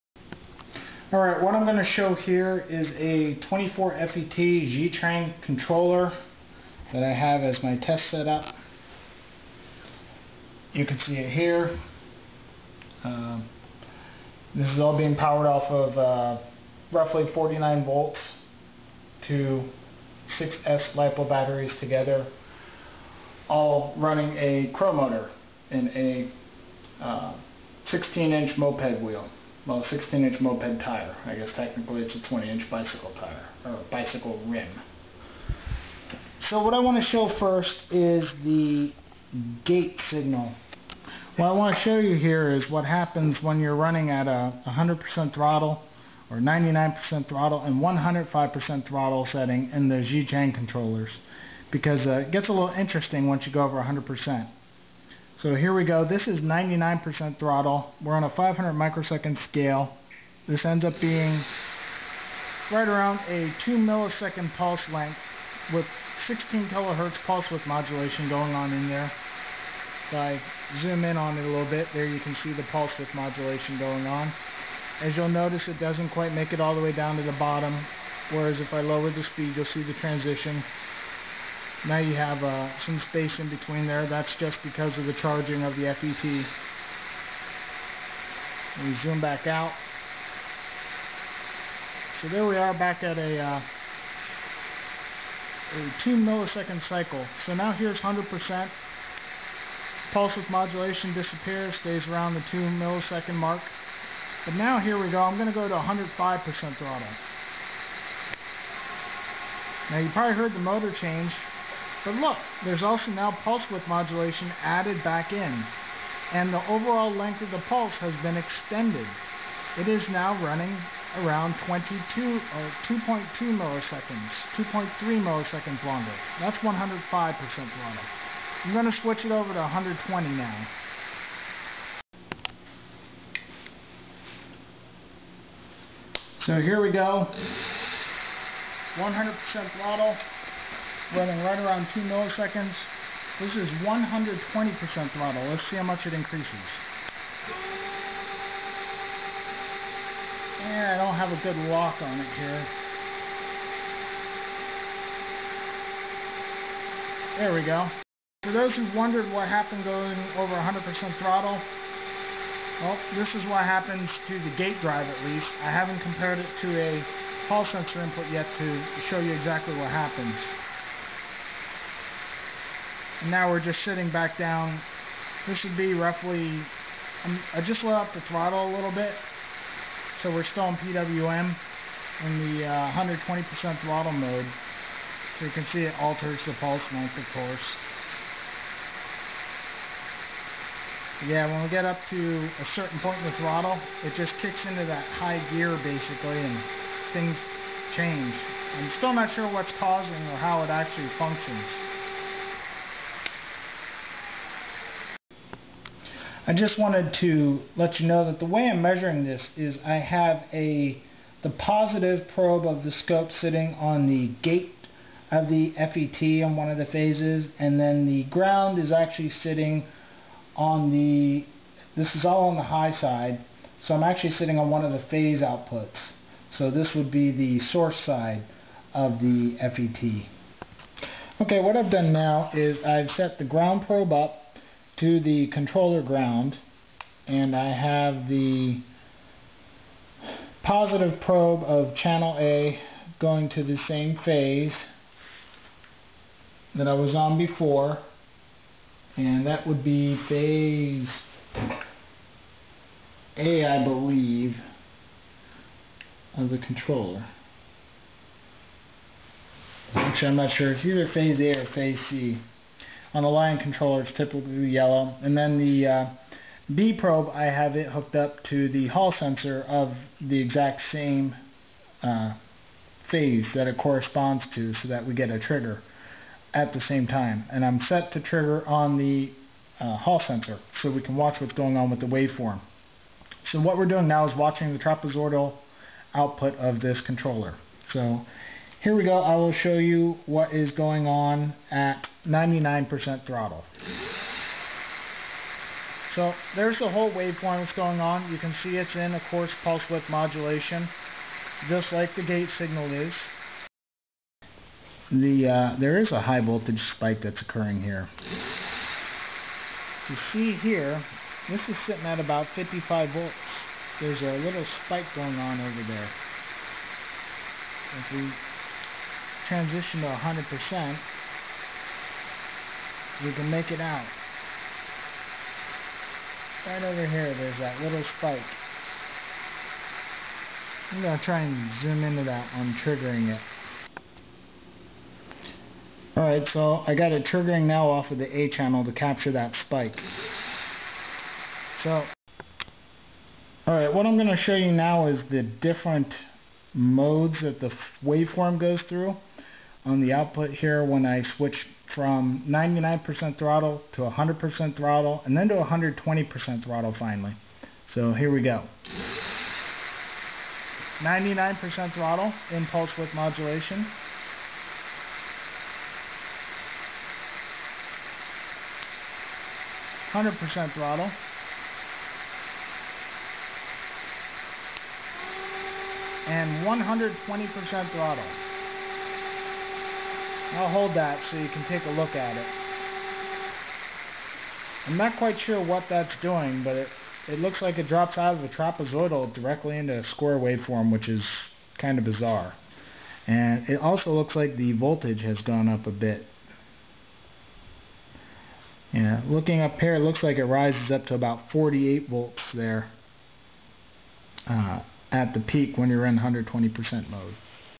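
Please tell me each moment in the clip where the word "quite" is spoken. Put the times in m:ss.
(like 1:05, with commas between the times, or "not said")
1:16, 6:25.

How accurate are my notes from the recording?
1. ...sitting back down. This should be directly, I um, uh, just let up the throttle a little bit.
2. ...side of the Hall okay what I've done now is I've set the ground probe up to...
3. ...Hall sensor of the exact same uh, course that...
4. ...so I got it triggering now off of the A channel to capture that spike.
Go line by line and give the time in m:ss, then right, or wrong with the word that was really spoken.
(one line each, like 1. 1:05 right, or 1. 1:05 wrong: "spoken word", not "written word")
1. 2:53 wrong: "roughly", not "directly"
2. 3:48 wrong: "FET", not "Hall"
3. 4:28 wrong: "phase", not "course"
4. 5:36 right.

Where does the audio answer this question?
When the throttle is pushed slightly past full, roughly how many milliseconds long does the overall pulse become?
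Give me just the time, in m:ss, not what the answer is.
2:04.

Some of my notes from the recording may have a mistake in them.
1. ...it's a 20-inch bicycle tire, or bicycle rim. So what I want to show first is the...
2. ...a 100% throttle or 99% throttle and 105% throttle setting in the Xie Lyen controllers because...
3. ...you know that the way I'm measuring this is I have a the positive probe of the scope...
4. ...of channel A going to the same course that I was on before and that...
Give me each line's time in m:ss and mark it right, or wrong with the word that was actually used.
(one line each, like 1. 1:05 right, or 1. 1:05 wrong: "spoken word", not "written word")
1. 0:32 right
2. 0:44 wrong: "Chang", not "Lyen"
3. 3:27 right
4. 4:01 wrong: "phase", not "course".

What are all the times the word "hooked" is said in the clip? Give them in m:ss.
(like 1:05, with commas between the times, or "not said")
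4:27.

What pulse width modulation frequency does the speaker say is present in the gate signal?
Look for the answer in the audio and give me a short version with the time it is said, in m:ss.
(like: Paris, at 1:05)
16 kilohertz, at 1:06.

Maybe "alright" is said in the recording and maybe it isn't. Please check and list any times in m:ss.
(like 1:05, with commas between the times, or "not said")
0:01, 5:36, 5:43.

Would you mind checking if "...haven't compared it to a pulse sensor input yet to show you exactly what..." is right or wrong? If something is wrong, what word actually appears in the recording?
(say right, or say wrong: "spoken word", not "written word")
right.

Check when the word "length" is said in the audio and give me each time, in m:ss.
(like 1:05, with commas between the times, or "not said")
1:04, 1:57, 3:06.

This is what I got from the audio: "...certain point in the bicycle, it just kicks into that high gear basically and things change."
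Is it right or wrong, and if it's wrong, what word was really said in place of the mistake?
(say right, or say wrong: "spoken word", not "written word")
wrong: "throttle", not "bicycle".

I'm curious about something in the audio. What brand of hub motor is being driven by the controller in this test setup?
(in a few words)
Cromotor.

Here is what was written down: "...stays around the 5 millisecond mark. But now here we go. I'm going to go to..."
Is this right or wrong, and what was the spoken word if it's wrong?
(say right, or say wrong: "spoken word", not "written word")
wrong: "2", not "5".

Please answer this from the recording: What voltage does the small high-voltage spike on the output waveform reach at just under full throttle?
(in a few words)
55 volts.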